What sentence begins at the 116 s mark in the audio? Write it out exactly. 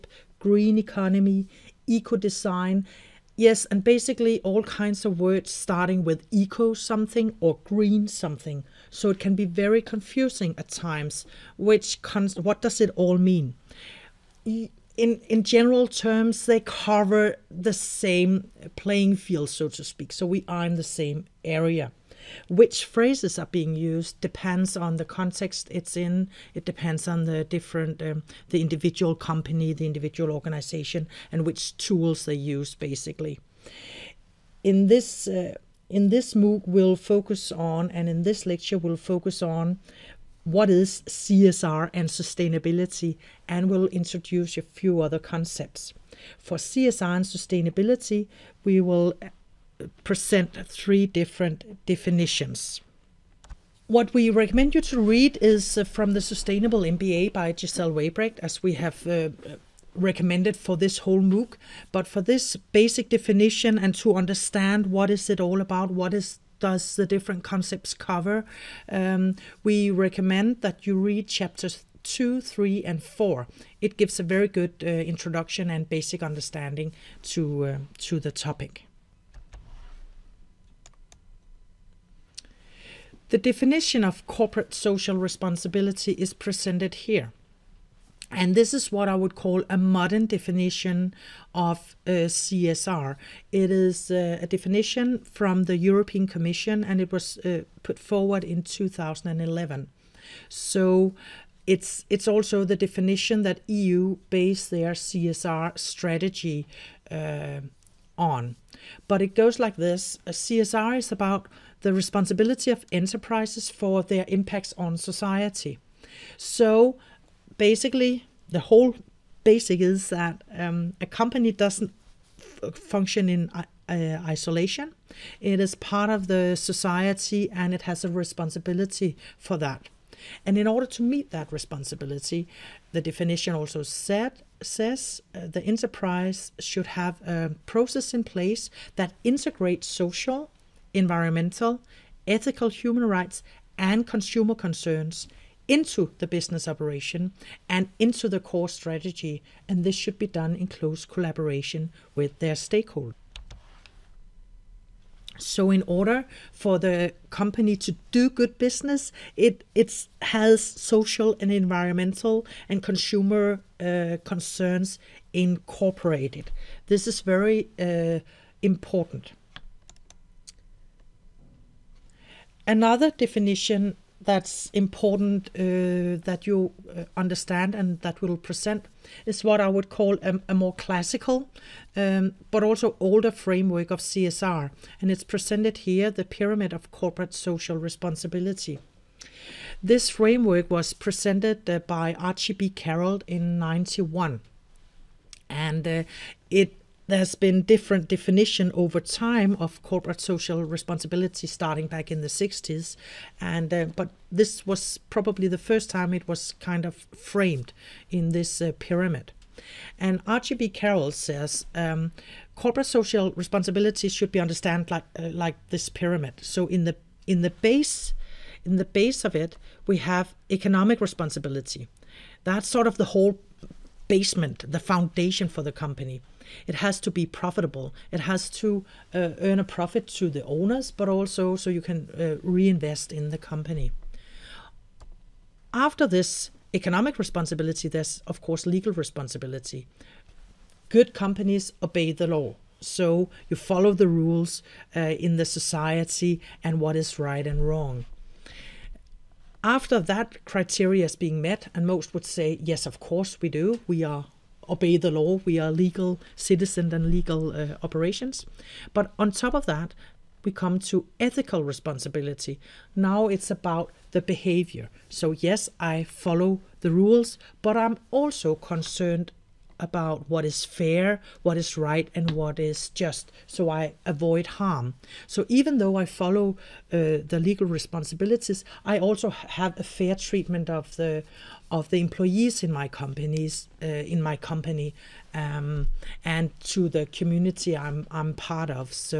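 So basically, the whole basic is that um, a company doesn't function in uh, uh, isolation.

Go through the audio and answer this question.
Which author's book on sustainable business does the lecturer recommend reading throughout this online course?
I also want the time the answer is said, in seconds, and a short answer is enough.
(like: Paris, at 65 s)
Giselle Weybrecht, at 57 s.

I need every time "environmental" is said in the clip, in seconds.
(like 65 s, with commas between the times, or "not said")
140 s, 161 s.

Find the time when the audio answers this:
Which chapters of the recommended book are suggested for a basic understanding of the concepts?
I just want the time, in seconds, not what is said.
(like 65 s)
71 s.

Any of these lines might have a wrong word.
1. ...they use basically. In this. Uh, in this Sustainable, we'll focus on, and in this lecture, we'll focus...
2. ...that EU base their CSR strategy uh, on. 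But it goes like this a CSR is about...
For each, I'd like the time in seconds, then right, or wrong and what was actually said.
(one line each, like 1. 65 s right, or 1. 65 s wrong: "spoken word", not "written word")
1. 32 s wrong: "MOOC", not "Sustainable"
2. 103 s right.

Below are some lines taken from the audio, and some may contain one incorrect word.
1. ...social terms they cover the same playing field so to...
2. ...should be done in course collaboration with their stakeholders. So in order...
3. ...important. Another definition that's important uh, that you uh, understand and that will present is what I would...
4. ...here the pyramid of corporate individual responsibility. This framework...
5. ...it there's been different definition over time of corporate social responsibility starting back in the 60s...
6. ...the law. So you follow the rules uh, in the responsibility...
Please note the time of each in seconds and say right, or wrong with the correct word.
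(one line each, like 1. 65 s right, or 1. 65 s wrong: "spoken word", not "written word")
1. 15 s wrong: "general", not "social"
2. 149 s wrong: "close", not "course"
3. 168 s right
4. 185 s wrong: "social", not "individual"
5. 196 s right
6. 242 s wrong: "society", not "responsibility".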